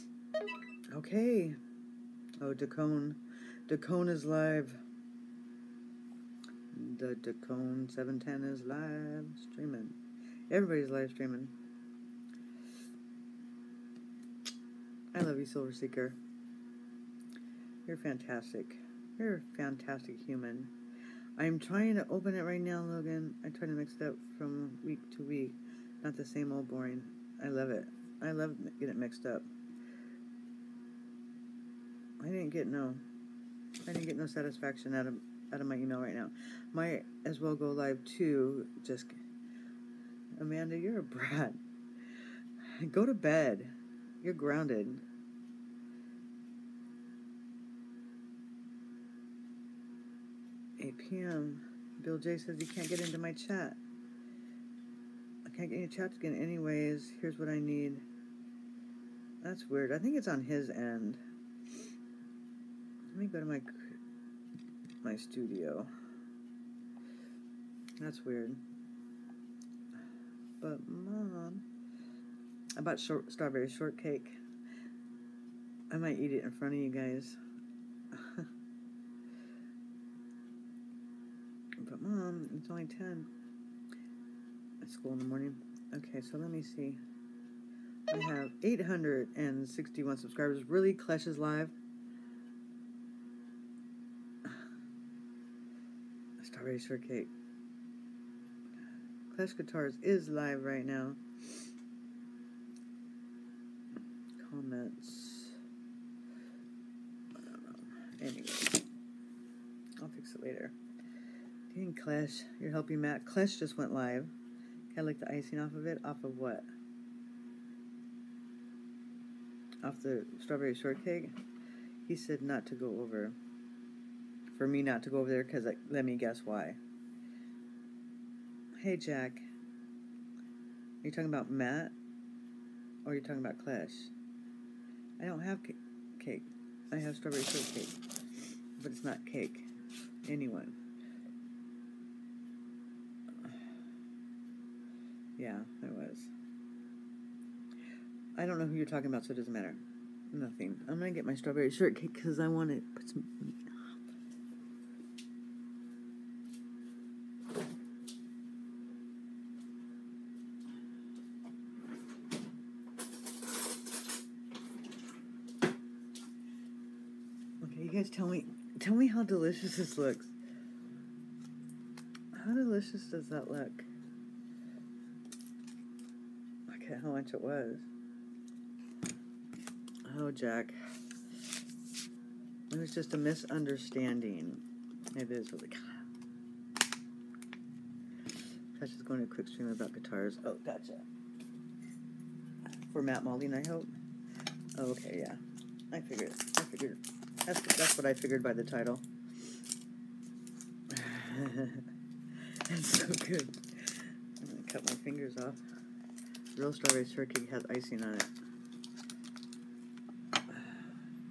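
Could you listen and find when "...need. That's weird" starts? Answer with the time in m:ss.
0:57.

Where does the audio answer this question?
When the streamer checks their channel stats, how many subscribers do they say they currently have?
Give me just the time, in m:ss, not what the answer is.
1:28.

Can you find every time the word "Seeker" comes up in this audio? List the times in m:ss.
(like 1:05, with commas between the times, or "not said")
0:15.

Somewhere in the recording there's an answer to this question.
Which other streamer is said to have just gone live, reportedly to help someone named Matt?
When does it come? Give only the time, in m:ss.
1:39.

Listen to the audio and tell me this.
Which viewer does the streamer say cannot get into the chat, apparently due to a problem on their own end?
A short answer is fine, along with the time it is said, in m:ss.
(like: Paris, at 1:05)
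Bill J, at 0:52.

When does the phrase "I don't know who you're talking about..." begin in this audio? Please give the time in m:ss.
2:28.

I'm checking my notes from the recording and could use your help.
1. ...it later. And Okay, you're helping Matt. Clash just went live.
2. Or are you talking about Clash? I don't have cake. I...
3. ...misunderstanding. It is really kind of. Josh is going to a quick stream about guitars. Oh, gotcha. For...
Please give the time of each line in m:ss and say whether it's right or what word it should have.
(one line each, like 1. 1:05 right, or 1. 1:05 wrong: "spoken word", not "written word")
1. 1:50 wrong: "Clash", not "Okay"
2. 2:13 right
3. 3:03 right.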